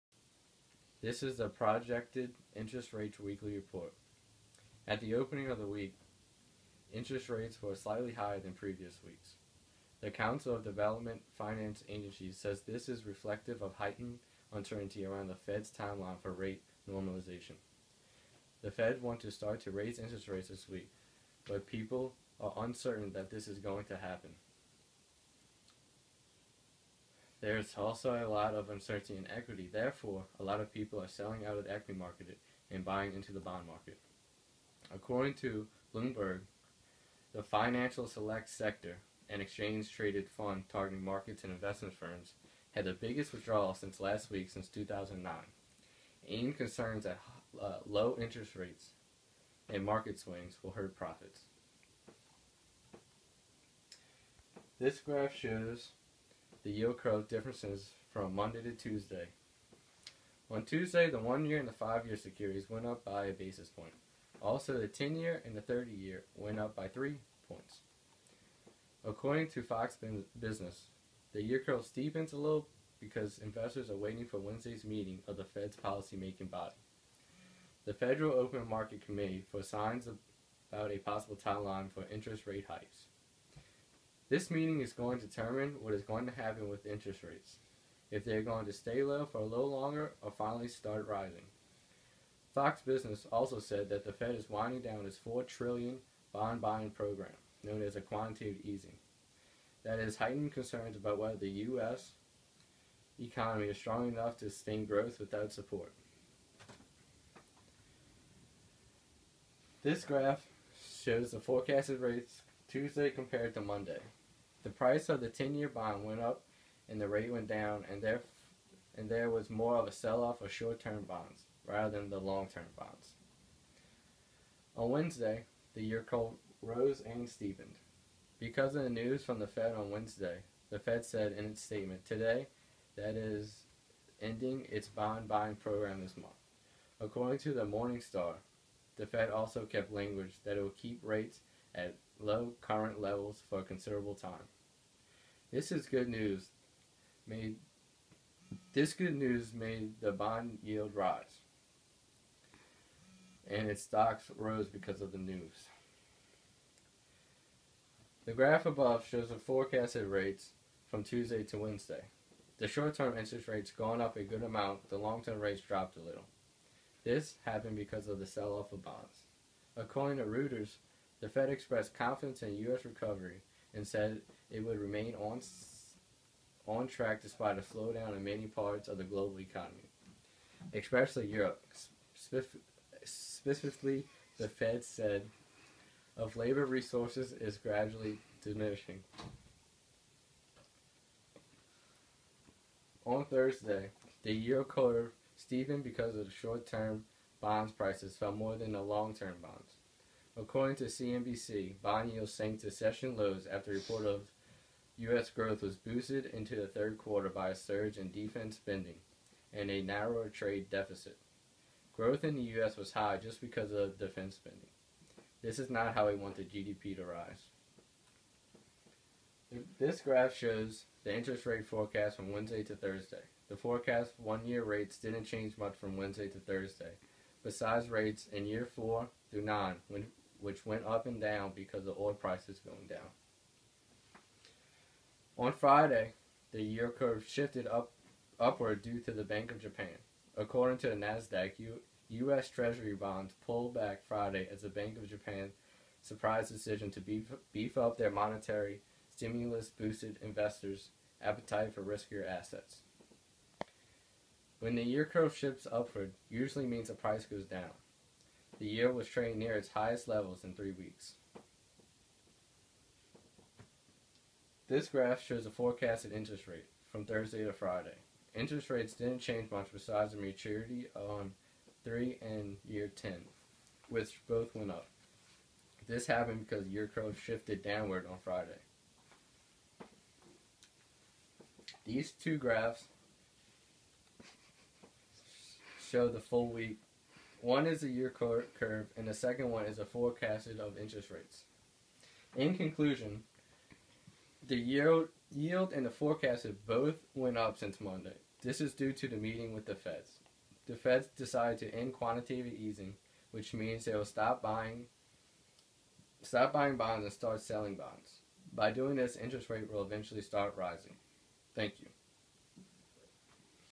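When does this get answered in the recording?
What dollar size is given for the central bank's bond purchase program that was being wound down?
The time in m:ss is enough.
1:35.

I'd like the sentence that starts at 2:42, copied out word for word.
The short-term interest rates gone up a good amount, the long-term rates dropped a little.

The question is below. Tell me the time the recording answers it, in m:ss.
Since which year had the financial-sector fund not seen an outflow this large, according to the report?
0:44.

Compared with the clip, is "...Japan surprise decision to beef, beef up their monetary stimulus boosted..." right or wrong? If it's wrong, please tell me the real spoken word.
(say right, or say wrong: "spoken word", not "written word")
right.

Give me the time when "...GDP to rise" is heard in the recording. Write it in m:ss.
3:36.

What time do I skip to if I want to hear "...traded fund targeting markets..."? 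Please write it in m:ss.
0:39.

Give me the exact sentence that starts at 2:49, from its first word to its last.
According to Reuters, the Fed expressed confidence in U.S.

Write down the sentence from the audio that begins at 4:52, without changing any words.
In conclusion, the yield, yield and the forecasted both went up since Monday.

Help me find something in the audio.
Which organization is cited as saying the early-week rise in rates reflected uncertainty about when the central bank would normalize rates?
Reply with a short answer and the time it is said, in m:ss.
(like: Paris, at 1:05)
Council of Development Finance Agencies, at 0:10.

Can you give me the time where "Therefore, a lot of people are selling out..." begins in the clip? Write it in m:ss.
0:29.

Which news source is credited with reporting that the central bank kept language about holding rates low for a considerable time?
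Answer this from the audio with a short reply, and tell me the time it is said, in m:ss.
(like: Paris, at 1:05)
Morningstar, at 2:17.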